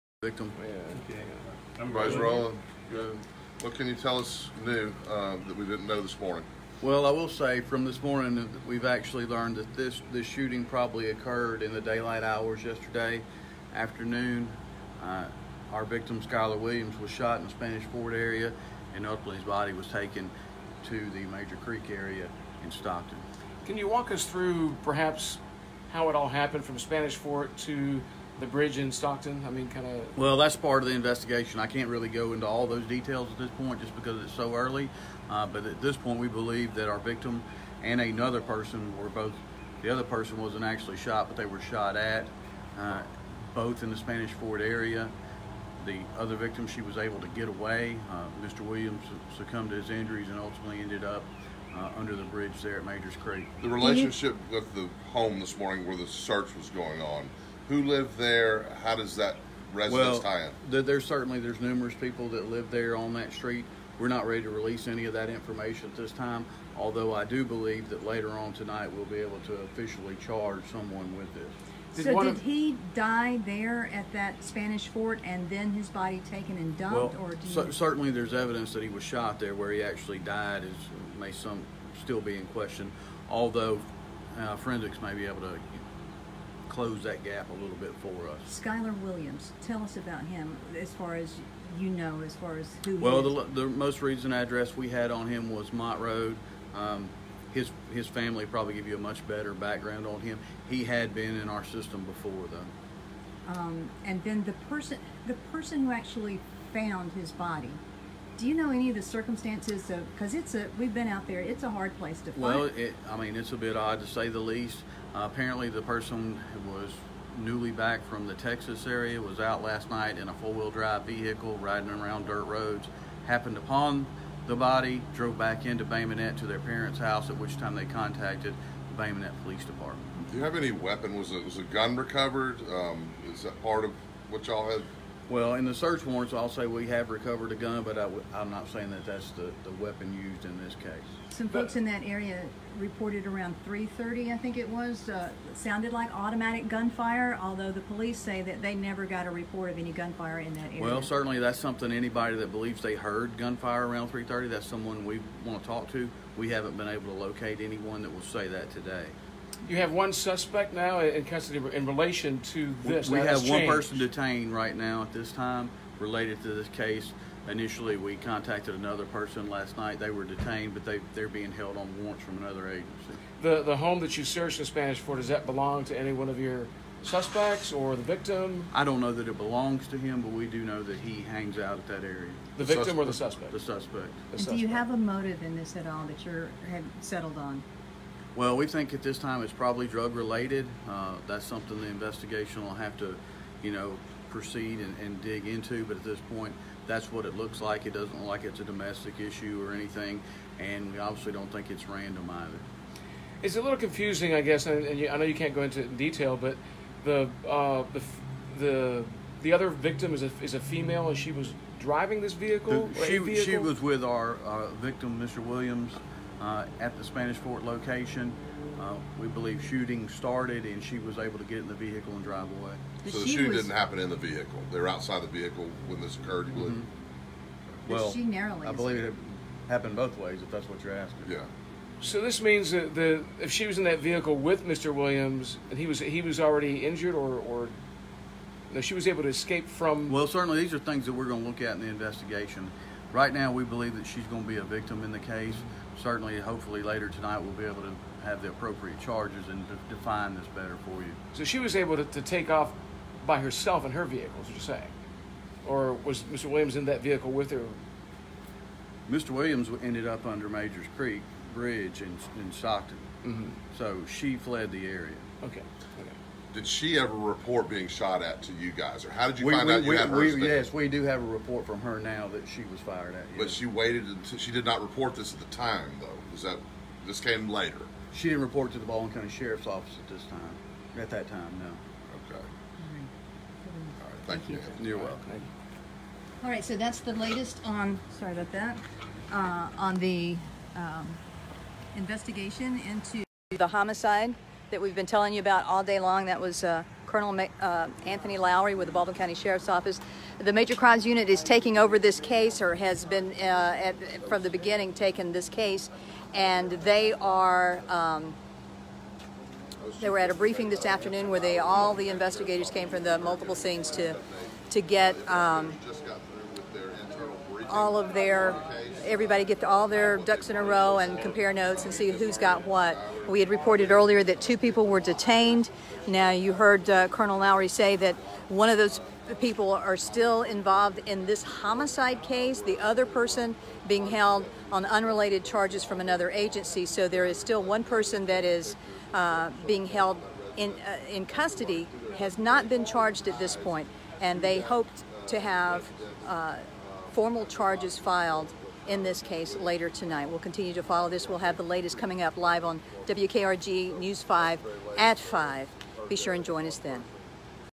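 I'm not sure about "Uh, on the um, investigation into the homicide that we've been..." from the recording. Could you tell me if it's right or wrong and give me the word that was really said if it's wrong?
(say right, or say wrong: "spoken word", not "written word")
right.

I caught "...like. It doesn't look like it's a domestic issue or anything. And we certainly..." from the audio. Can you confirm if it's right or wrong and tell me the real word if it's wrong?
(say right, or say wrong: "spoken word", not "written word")
wrong: "obviously", not "certainly".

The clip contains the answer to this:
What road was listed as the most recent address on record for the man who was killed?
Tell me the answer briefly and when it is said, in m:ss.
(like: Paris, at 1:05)
Mott Road, at 1:35.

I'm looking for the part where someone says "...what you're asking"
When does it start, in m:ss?
3:50.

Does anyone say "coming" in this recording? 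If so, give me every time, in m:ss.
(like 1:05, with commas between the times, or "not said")
5:51.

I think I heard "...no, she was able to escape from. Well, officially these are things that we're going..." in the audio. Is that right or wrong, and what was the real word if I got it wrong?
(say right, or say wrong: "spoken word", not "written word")
wrong: "certainly", not "officially".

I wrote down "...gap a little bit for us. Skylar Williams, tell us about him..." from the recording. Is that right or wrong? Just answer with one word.
right.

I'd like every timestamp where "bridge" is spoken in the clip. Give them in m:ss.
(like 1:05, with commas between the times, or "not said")
0:28, 0:52, 4:21.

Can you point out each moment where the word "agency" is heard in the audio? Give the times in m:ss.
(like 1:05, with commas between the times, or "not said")
2:52, 5:36.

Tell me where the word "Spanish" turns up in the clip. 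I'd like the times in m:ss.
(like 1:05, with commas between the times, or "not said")
0:17, 0:26, 0:43, 1:14, 2:54, 3:37.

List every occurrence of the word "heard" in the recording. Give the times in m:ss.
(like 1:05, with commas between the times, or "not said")
2:32, 5:26.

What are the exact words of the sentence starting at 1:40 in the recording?
He had been in our system before, though.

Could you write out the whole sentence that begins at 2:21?
Some but, folks in that area reported around 3:30, I think it was, uh, sounded like automatic gunfire.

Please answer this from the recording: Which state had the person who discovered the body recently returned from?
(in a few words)
Texas.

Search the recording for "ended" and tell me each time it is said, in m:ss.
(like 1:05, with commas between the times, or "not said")
0:50, 4:19.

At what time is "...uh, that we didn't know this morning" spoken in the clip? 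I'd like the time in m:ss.
0:05.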